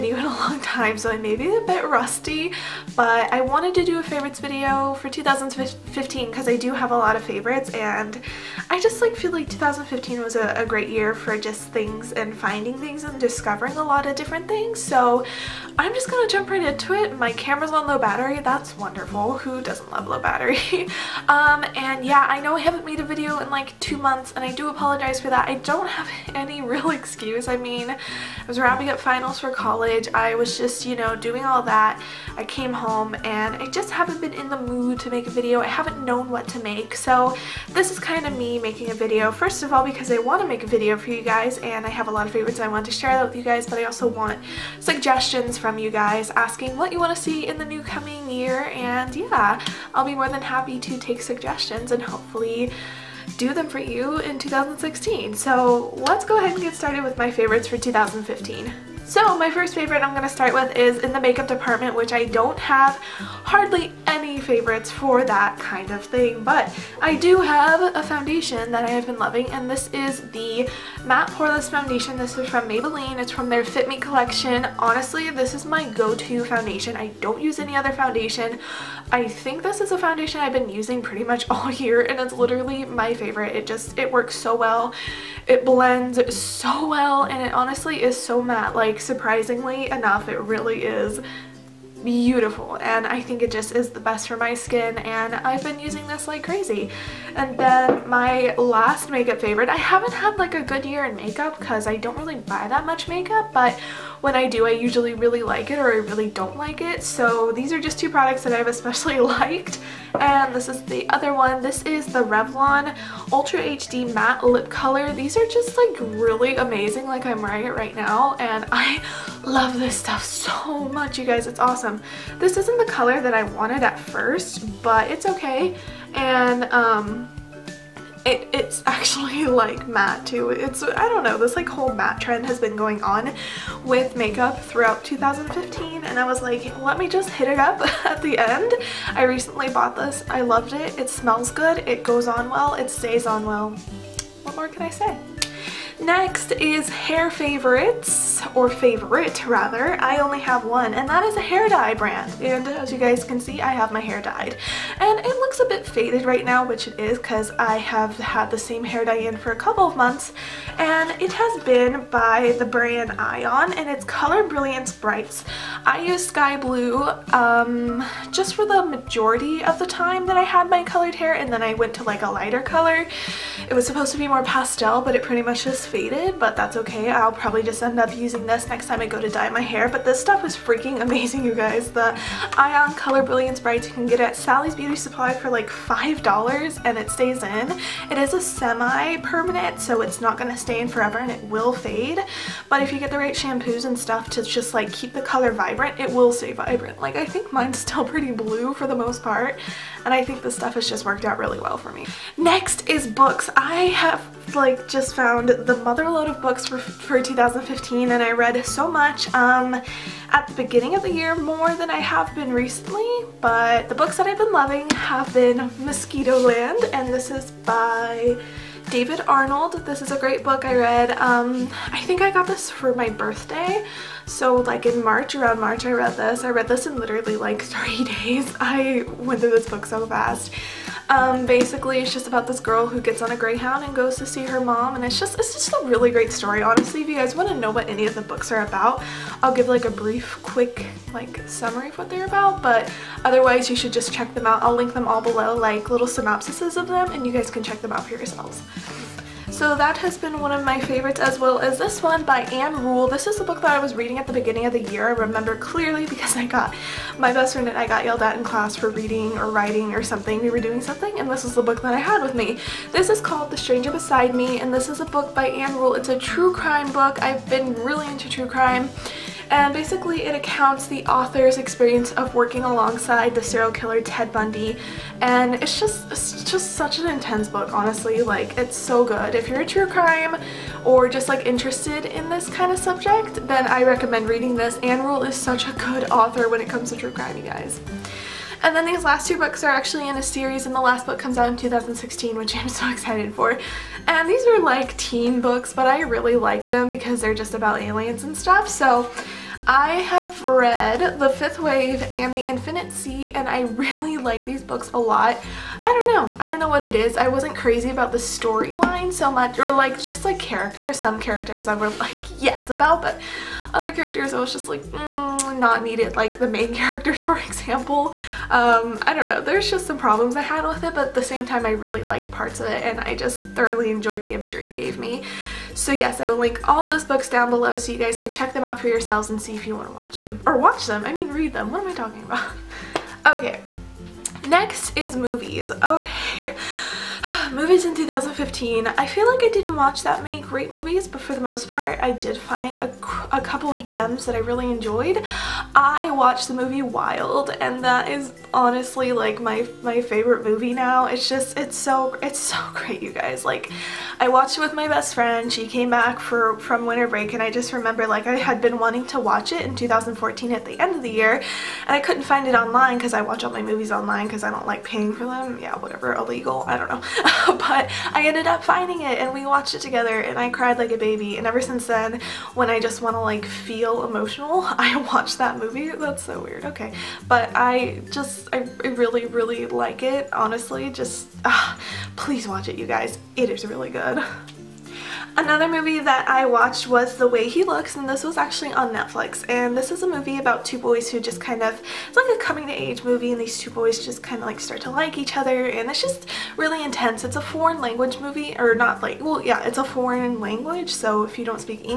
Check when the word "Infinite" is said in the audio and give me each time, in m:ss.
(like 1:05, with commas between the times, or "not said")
5:02.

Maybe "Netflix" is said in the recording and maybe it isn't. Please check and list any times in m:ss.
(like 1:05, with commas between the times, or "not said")
6:28.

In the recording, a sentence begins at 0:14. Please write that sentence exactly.
So I'm just gonna jump right into it.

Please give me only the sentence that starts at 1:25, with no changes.
It blends so well, and it honestly is so matte.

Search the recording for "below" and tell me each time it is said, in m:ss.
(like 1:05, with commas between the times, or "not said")
4:05, 5:27.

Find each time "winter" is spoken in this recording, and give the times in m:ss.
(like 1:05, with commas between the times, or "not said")
5:56.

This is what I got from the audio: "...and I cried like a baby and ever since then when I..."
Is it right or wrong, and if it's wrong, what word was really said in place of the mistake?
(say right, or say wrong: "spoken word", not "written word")
right.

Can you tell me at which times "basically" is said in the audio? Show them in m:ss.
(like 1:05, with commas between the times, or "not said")
3:51, 4:29.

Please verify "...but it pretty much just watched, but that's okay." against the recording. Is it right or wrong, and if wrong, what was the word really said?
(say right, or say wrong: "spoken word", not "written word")
wrong: "faded", not "watched".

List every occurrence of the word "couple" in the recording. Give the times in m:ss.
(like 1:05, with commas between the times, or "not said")
2:39, 5:43.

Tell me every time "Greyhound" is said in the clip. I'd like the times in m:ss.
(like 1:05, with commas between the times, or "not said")
3:53.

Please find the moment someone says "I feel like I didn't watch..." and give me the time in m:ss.
5:38.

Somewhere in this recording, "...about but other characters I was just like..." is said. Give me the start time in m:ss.
5:12.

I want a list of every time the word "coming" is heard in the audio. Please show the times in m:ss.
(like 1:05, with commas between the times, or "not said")
0:47, 6:32.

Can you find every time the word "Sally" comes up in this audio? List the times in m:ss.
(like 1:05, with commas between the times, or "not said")
3:04.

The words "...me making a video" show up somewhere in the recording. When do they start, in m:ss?
0:38.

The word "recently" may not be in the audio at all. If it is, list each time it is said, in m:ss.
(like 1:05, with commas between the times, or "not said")
2:19, 3:32.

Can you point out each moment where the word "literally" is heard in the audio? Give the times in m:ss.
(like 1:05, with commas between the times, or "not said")
1:22, 3:46.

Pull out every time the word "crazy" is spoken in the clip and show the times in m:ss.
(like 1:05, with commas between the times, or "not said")
1:36, 5:07.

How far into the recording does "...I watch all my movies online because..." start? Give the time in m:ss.
6:03.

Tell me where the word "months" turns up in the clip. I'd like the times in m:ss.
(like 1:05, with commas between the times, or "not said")
0:23, 2:39.